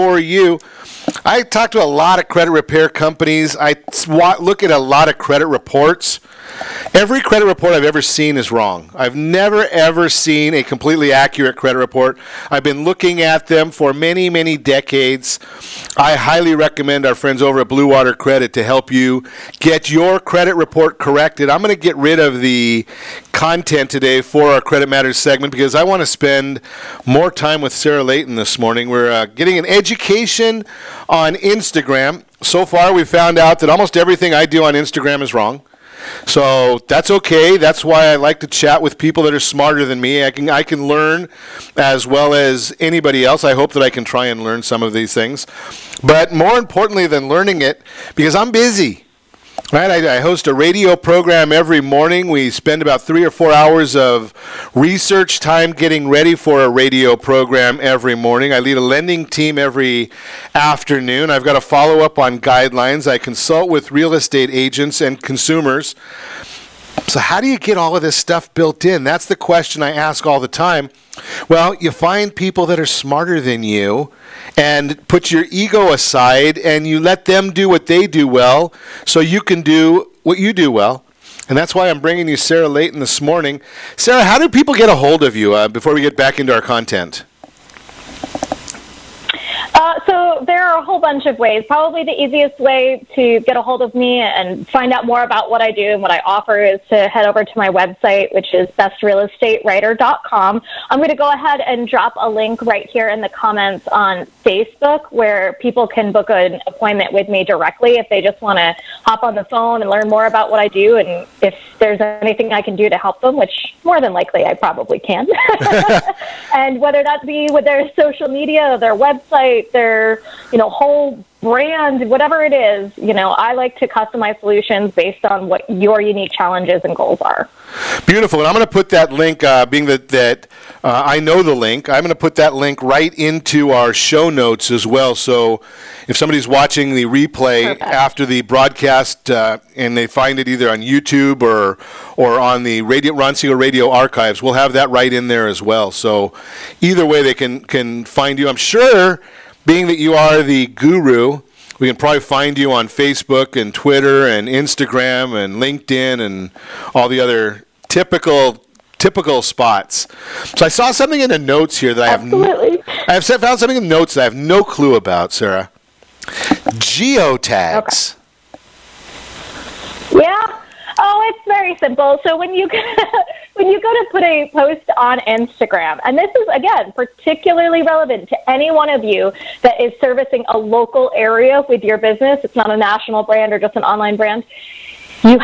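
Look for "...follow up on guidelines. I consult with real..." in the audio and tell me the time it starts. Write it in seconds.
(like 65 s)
61 s.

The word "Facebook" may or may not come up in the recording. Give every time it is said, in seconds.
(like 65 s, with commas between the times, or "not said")
104 s, 152 s.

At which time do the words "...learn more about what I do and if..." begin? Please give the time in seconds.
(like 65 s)
109 s.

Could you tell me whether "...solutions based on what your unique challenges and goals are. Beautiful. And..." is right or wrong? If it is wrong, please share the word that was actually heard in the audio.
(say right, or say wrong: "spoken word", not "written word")
right.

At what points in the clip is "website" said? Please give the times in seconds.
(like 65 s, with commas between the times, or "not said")
97 s, 118 s.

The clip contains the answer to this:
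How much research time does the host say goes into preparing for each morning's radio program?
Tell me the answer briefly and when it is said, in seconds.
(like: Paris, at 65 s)
3 or 4 hours, at 53 s.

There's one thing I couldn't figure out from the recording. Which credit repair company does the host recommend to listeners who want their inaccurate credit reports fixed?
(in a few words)
Blue Water Credit.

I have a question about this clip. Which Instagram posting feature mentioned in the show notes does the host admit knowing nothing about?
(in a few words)
Geotags.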